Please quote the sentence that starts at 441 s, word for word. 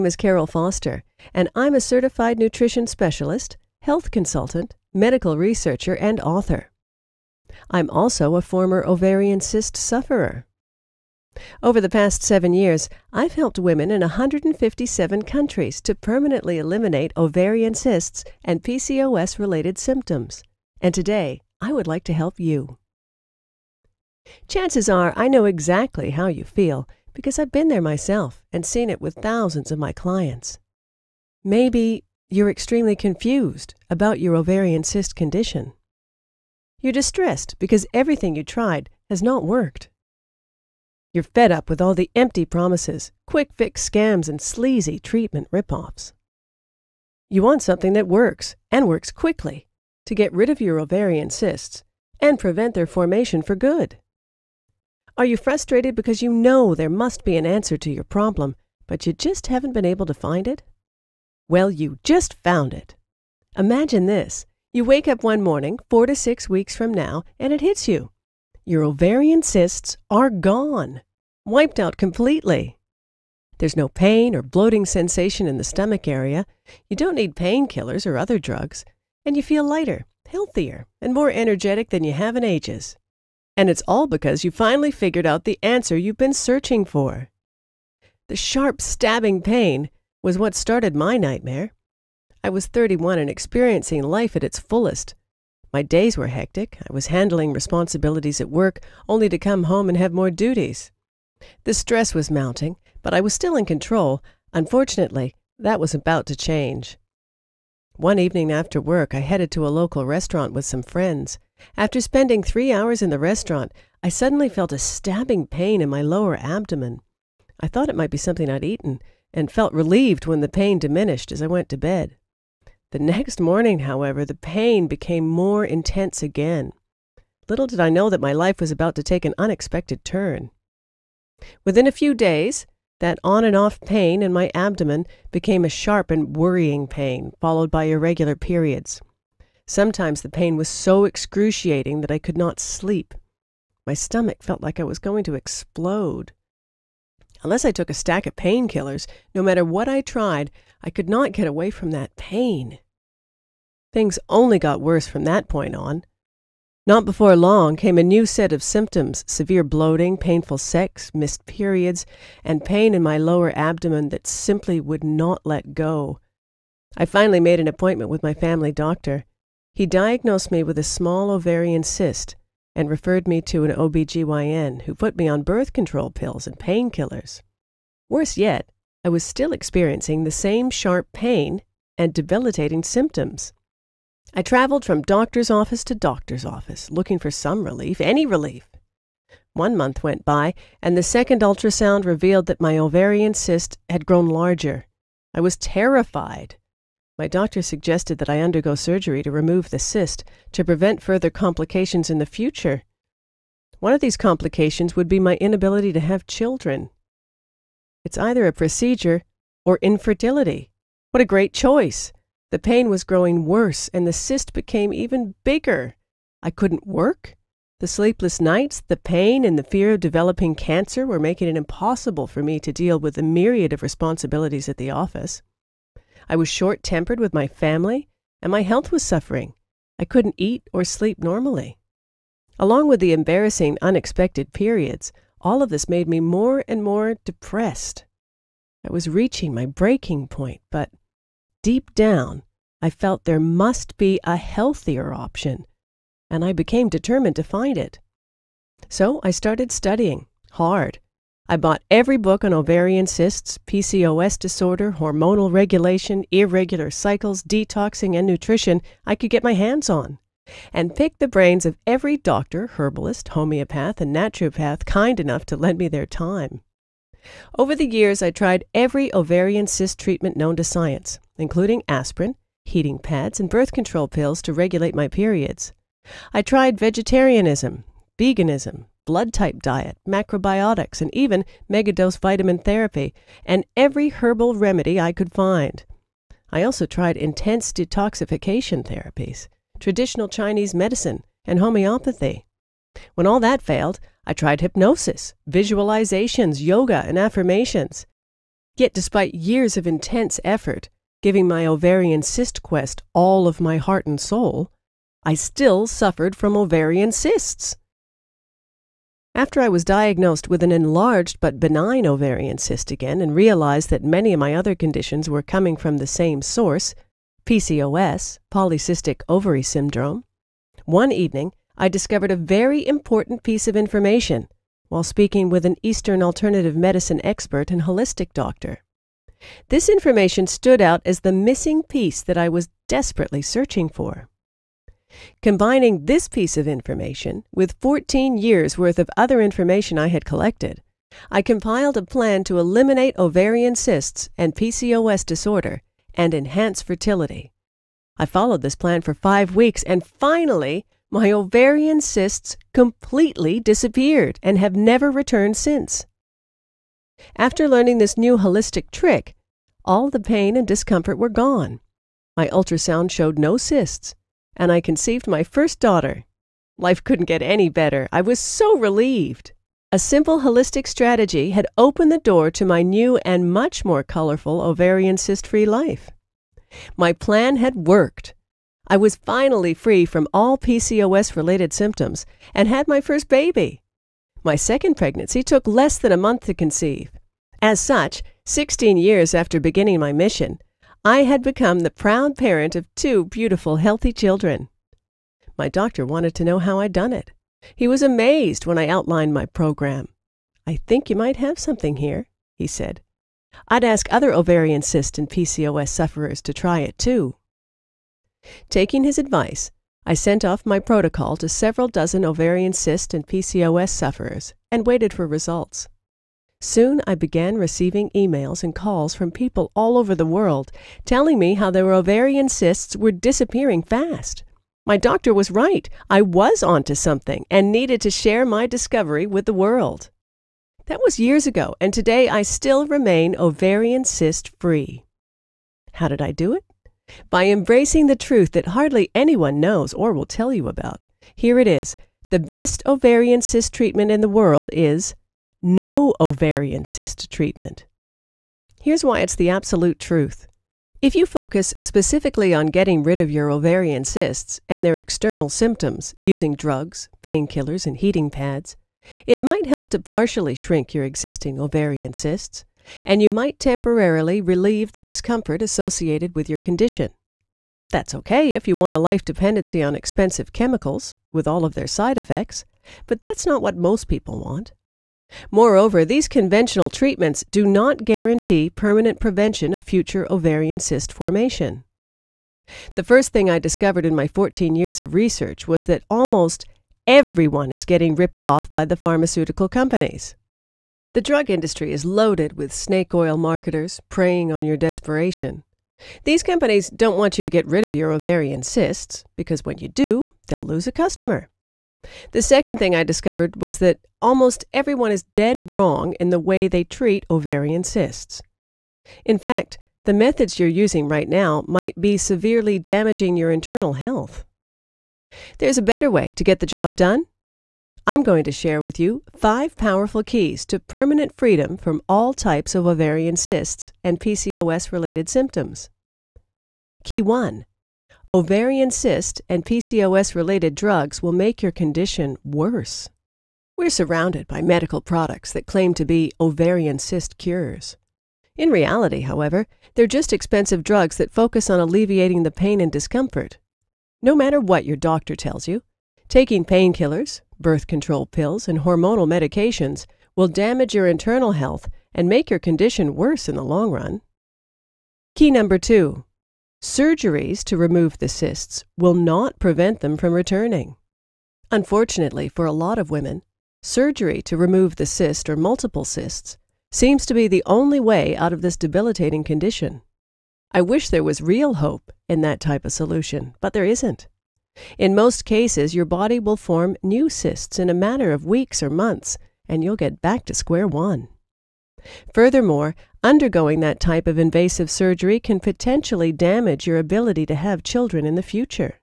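Here it is the best ovarian cyst treatment in the world is no ovarian cyst treatment.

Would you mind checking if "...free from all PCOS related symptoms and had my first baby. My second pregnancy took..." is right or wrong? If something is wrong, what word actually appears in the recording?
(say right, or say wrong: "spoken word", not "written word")
right.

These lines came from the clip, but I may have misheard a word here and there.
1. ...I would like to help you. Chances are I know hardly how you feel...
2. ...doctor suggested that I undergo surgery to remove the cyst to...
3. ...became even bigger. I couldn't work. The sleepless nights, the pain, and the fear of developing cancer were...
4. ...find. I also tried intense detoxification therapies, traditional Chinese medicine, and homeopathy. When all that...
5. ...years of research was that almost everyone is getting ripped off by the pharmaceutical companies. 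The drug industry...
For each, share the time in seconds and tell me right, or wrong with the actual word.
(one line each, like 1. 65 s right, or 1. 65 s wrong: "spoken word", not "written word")
1. 21 s wrong: "exactly", not "hardly"
2. 197 s right
3. 214 s right
4. 285 s right
5. 484 s right.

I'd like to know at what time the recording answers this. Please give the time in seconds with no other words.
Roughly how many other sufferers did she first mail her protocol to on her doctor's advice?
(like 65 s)
411 s.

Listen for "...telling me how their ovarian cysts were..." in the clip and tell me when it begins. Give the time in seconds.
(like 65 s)
421 s.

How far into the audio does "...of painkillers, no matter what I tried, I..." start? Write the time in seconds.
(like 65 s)
148 s.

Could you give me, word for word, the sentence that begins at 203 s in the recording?
One of these complications would be my inability to have children.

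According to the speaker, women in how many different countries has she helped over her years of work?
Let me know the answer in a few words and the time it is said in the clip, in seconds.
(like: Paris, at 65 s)
157, at 14 s.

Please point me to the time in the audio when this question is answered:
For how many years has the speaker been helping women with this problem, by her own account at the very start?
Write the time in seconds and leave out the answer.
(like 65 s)
12 s.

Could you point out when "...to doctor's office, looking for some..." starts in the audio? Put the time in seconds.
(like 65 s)
185 s.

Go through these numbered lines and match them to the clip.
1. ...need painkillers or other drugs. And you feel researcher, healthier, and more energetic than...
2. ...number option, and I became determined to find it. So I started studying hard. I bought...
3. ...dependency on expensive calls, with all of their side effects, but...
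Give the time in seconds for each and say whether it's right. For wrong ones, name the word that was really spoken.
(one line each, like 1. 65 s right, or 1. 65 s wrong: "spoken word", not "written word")
1. 77 s wrong: "lighter", not "researcher"
2. 244 s wrong: "healthier", not "number"
3. 469 s wrong: "chemicals", not "calls".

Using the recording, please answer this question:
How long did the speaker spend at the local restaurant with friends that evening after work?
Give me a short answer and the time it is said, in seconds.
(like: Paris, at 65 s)
three hours, at 112 s.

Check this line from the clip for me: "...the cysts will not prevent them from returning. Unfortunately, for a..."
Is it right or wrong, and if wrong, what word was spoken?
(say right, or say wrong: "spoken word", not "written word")
right.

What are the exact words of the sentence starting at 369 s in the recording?
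A simple holistic strategy had opened the door to my new and much more colorful ovarian cyst free life.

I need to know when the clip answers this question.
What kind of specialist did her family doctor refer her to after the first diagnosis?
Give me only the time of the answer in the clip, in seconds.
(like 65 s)
173 s.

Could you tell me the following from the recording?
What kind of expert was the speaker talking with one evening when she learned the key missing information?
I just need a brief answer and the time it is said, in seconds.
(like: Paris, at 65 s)
Eastern alternative medicine expert, at 325 s.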